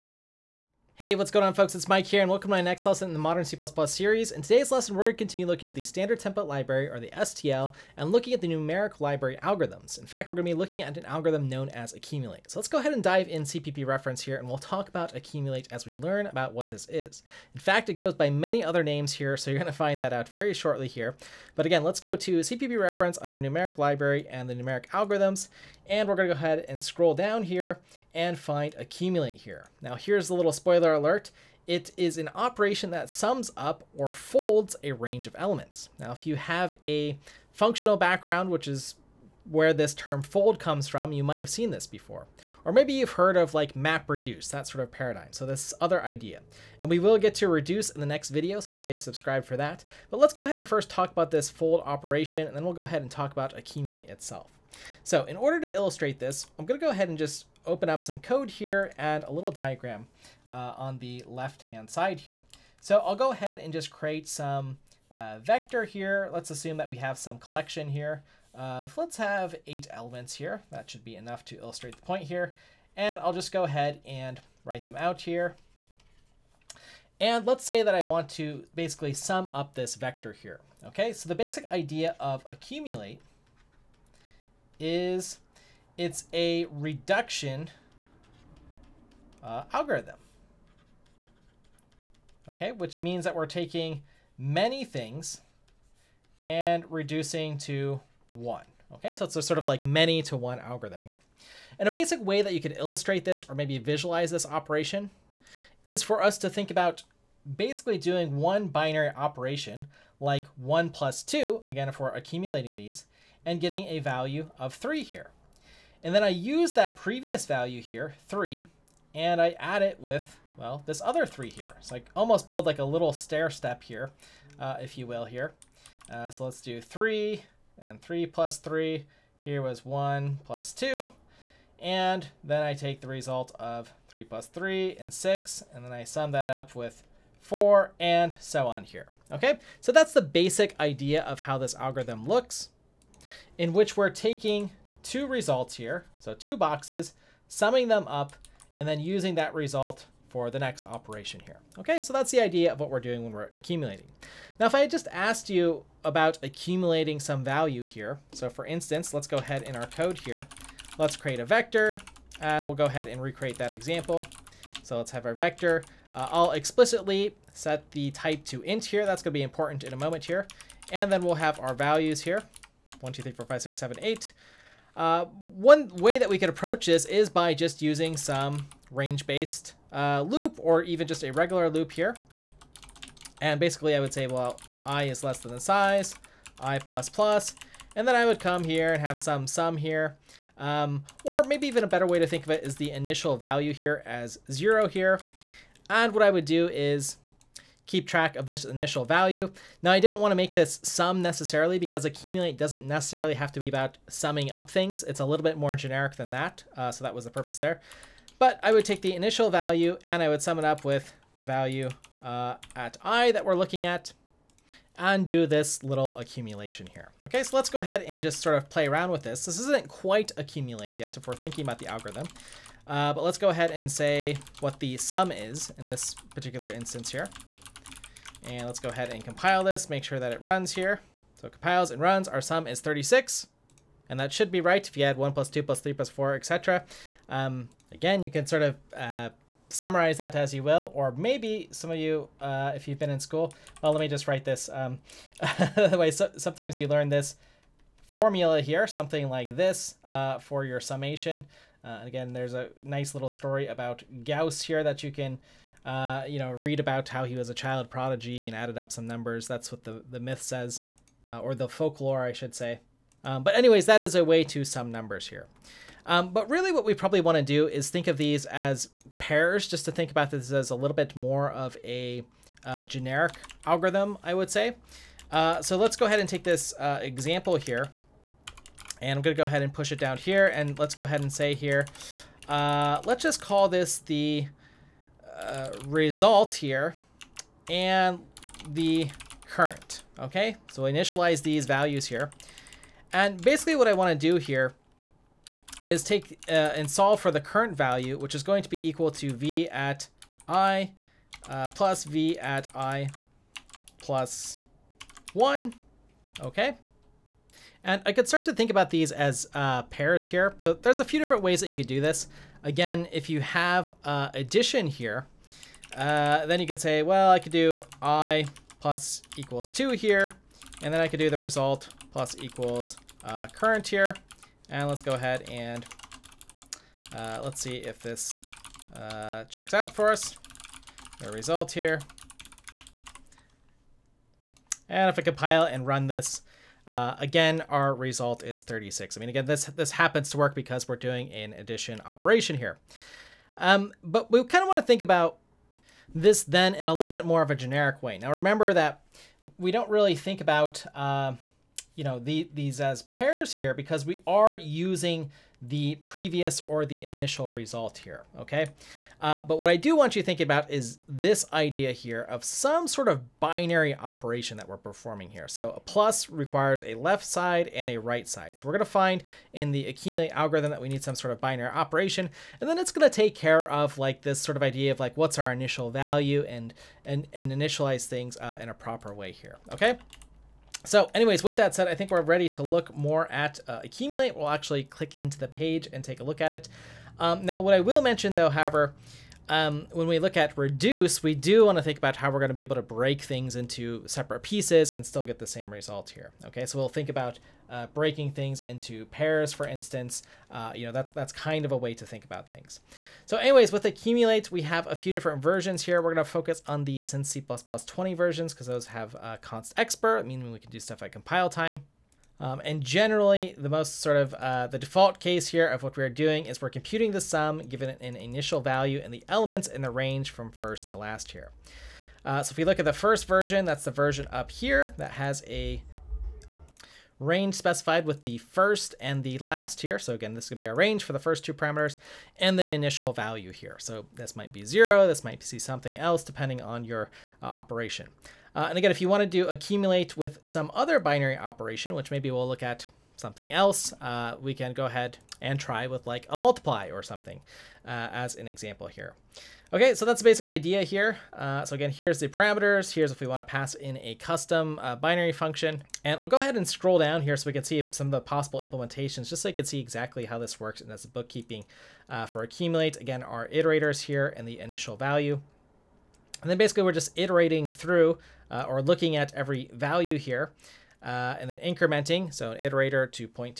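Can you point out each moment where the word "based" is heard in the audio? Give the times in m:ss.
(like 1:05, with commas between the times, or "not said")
2:58.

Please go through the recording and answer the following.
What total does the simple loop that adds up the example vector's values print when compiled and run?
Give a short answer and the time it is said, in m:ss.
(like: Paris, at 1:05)
36, at 3:52.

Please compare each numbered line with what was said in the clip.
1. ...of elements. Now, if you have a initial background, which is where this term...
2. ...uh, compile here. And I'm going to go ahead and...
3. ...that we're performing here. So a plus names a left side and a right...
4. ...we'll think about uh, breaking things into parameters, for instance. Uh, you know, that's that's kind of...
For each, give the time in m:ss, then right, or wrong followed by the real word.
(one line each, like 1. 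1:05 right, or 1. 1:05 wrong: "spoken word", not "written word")
1. 0:35 wrong: "functional", not "initial"
2. 4:36 wrong: "example", not "compile"
3. 6:04 wrong: "requires", not "names"
4. 6:36 wrong: "pairs", not "parameters".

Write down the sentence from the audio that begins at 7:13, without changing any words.
So this might be zero, this might be something else depending on your uh, operation.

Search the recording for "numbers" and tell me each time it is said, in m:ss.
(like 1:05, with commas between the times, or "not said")
4:19, 4:24.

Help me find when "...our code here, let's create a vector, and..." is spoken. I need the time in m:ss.
2:39.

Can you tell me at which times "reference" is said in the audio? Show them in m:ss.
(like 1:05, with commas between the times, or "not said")
0:13, 0:22.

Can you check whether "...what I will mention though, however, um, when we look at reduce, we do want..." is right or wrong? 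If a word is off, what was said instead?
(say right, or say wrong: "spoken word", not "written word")
right.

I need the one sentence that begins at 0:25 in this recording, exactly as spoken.
And we're going to go ahead and scroll down here and find accumulate here.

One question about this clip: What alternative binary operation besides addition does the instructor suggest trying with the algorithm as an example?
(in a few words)
multiply.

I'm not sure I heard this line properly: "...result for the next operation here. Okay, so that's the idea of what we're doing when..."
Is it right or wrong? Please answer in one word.
right.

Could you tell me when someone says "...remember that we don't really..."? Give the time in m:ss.
5:48.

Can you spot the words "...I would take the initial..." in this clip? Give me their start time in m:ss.
3:28.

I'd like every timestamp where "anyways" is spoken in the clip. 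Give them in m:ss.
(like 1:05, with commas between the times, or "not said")
4:23, 6:21, 6:43.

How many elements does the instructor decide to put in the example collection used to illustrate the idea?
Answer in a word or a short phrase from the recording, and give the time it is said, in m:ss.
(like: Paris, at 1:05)
8, at 1:09.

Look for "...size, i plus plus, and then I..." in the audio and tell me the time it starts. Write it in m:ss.
3:05.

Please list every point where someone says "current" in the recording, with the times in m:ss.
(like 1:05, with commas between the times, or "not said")
4:49, 4:57, 5:23.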